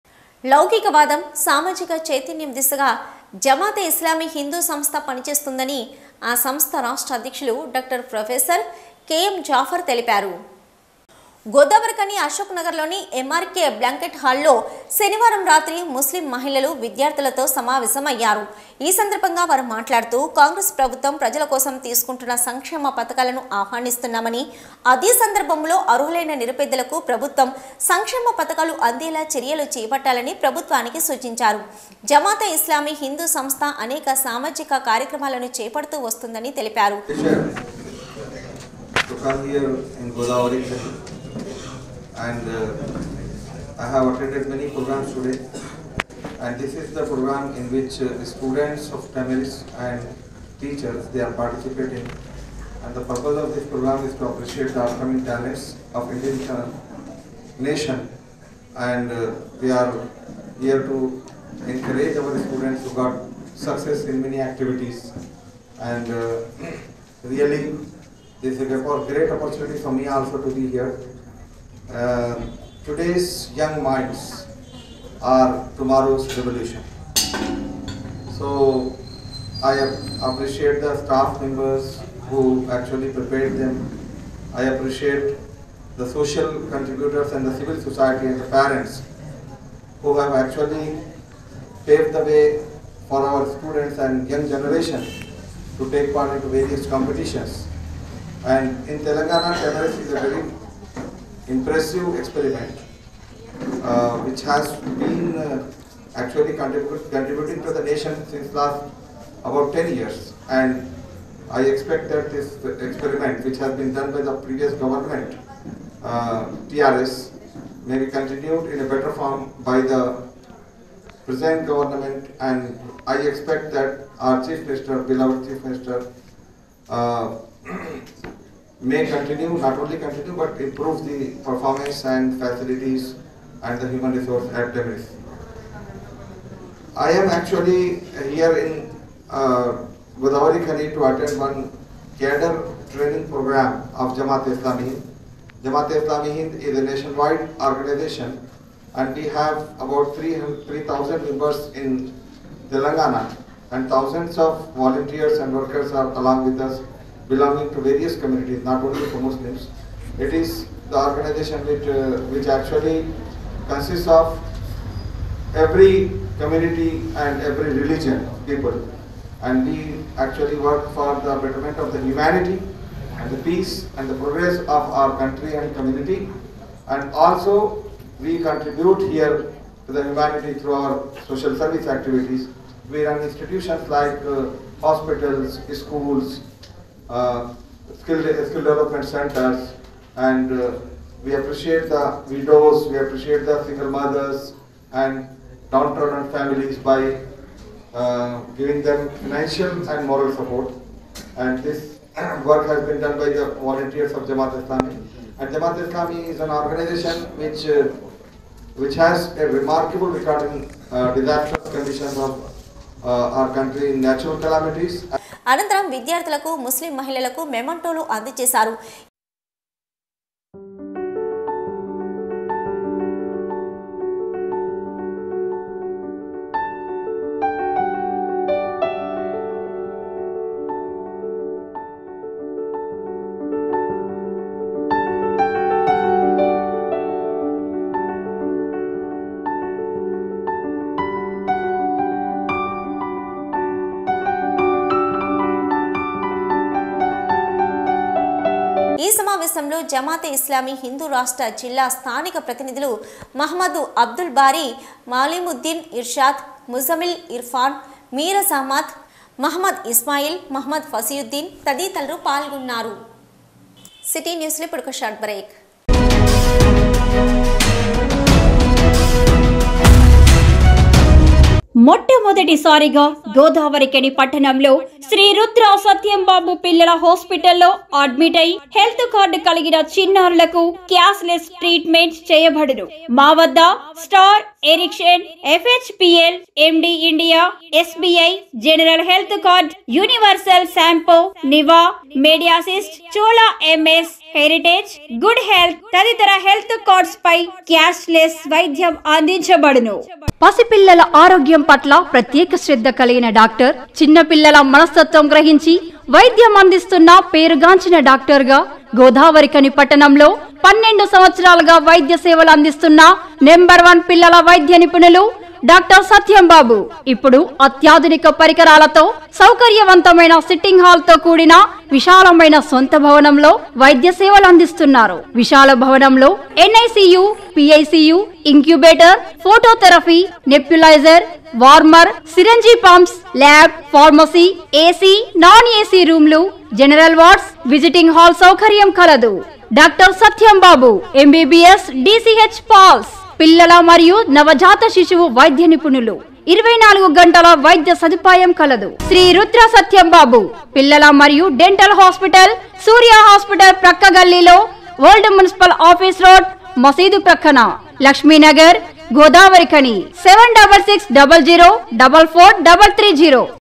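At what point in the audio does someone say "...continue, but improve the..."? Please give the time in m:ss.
2:09.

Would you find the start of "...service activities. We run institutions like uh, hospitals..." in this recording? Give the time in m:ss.
3:01.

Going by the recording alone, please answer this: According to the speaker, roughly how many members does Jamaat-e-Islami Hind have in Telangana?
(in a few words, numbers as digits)
3,000.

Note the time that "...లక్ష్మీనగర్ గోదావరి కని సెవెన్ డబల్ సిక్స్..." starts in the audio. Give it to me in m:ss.
5:58.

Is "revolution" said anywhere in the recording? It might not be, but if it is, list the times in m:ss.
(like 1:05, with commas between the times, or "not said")
1:16.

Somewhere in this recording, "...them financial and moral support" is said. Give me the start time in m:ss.
3:18.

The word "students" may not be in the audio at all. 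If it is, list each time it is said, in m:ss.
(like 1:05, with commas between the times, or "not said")
0:48, 1:02, 1:33.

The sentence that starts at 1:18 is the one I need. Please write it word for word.
So I appreciate the staff members who actually prepared them.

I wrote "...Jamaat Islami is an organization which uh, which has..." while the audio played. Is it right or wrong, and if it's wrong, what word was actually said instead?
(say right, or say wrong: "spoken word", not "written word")
right.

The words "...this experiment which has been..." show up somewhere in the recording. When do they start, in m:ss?
1:52.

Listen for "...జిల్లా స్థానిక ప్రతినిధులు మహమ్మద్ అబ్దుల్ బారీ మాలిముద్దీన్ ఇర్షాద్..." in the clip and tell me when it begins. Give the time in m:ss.
4:11.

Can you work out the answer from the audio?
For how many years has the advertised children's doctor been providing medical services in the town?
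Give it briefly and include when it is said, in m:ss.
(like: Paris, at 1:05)
12, at 5:10.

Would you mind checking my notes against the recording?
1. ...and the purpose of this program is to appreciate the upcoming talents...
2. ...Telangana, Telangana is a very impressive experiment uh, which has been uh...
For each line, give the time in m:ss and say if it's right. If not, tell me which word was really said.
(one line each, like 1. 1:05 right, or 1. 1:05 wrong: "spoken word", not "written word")
1. 0:52 right
2. 1:38 right.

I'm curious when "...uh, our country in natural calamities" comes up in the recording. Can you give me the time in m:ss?
3:33.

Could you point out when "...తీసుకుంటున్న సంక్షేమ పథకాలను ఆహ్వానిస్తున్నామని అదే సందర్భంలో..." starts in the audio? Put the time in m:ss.
0:21.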